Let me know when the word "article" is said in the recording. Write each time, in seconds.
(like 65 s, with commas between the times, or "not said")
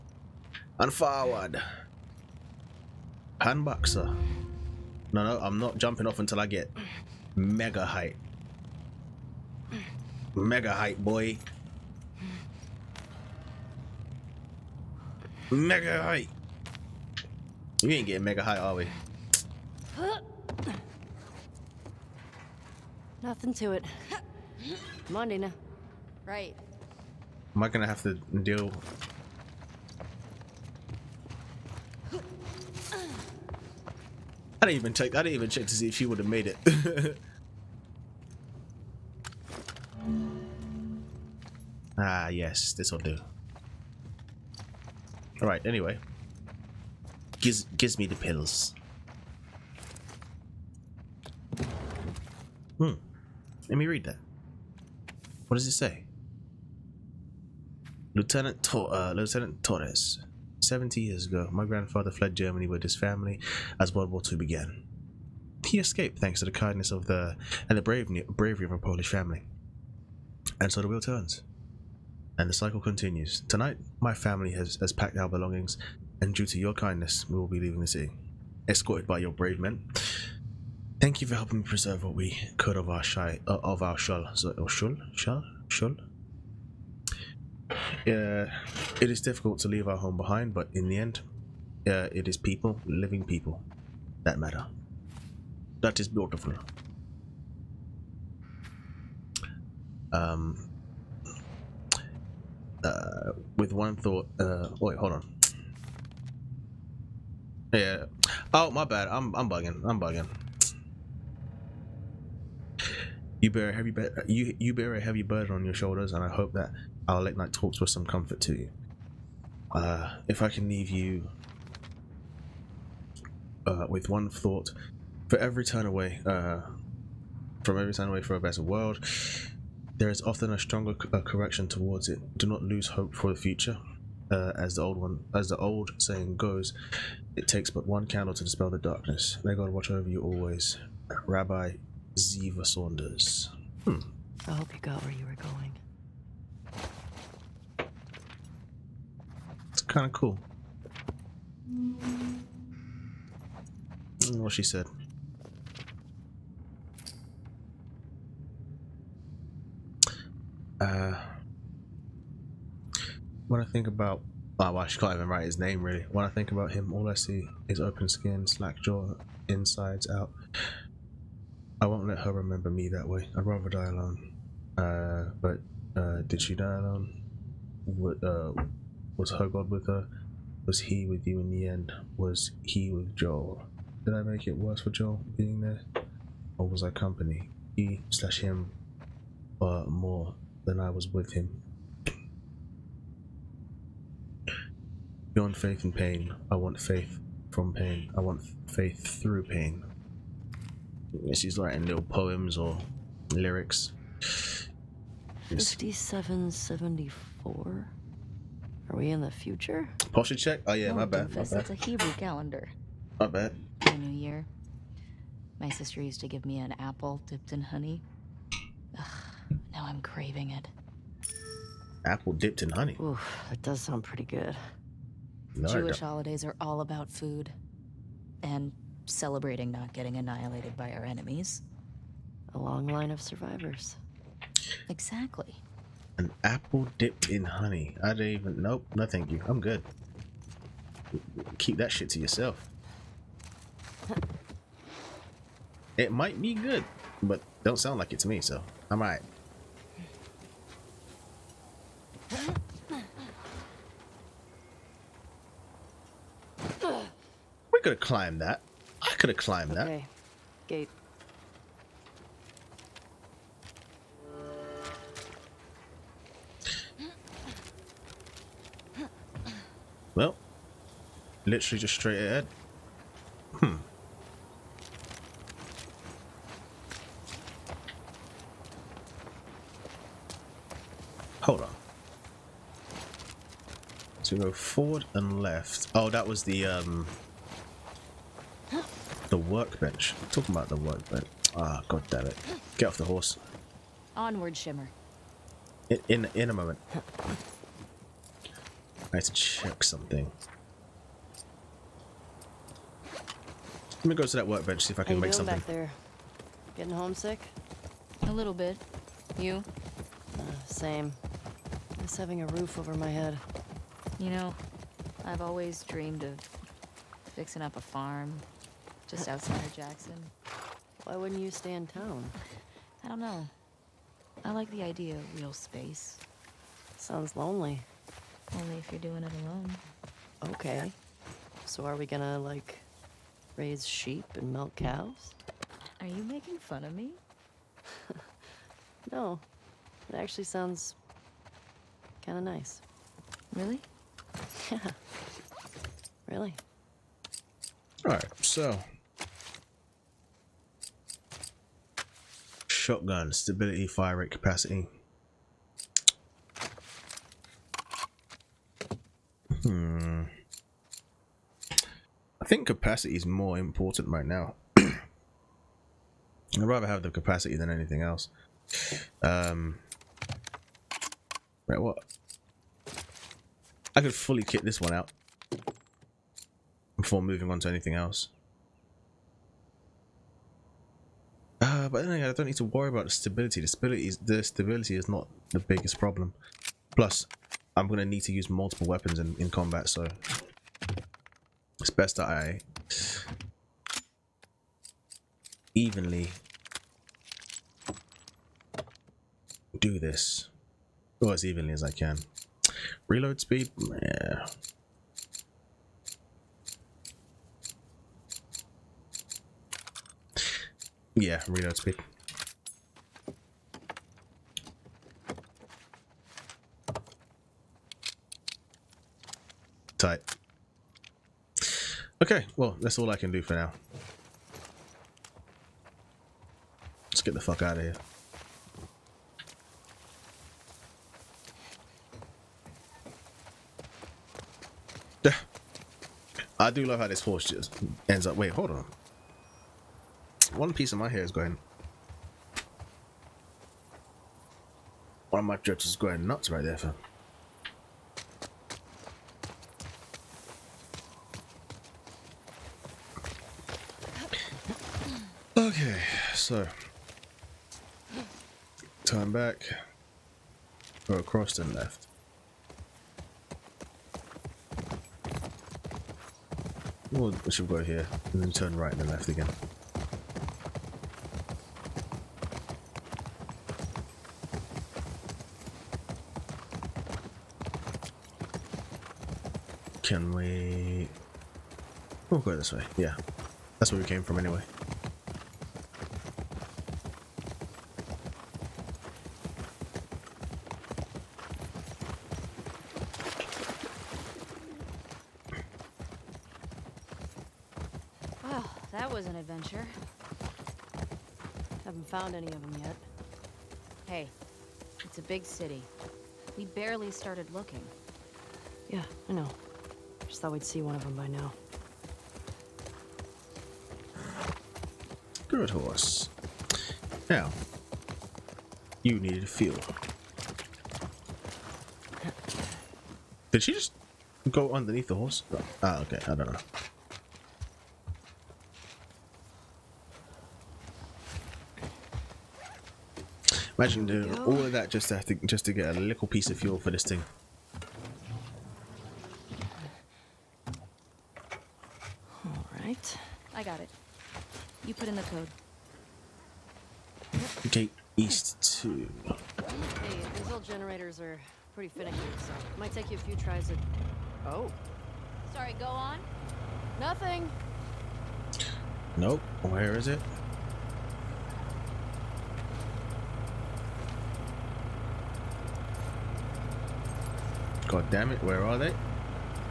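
not said.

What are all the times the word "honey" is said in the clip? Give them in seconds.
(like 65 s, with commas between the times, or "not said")
217 s, 222 s, 237 s.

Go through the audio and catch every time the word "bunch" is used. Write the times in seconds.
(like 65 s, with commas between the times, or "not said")
not said.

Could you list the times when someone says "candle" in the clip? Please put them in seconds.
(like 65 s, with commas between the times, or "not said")
138 s.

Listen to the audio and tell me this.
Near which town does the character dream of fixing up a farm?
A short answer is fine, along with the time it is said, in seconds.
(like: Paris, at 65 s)
Jackson, at 319 s.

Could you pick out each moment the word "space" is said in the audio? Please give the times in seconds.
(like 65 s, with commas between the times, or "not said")
325 s.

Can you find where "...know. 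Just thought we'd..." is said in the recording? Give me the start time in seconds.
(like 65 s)
509 s.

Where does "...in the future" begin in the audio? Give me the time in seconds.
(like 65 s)
209 s.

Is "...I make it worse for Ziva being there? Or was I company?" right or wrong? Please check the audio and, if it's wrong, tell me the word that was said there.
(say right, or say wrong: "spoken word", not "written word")
wrong: "Joel", not "Ziva".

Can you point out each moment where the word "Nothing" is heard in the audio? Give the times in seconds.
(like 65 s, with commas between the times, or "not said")
23 s, 556 s.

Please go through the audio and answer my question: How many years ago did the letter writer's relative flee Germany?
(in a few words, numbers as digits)
70.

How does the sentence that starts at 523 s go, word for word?
Did she just go underneath the horse?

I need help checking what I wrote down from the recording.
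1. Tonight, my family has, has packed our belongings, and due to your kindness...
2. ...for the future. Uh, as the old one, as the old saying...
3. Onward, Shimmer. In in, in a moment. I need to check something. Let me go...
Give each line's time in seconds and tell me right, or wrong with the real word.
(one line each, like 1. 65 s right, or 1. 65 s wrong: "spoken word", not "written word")
1. 73 s right
2. 133 s right
3. 294 s right.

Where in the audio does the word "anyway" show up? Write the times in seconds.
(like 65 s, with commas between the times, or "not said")
45 s, 382 s, 484 s.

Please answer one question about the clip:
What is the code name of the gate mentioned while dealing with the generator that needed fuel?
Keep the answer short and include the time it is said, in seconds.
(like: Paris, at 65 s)
Gate East 2, at 547 s.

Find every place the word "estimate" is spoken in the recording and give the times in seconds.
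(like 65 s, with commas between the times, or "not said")
not said.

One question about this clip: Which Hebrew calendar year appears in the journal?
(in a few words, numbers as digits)
5774.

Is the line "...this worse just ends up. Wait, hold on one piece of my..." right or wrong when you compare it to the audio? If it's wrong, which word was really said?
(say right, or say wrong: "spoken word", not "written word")
wrong: "horse", not "worse".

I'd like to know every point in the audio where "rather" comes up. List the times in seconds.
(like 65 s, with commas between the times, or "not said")
173 s, 366 s.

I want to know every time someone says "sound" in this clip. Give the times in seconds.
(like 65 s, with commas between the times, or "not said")
223 s, 247 s, 326 s, 340 s.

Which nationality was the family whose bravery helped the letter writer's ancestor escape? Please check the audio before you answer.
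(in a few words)
Polish.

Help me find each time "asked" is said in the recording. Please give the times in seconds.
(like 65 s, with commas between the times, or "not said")
not said.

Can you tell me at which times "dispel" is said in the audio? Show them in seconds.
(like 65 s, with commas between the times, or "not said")
138 s.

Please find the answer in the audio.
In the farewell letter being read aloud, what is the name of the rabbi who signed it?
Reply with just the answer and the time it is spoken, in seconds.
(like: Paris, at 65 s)
Ziva Saunders, at 141 s.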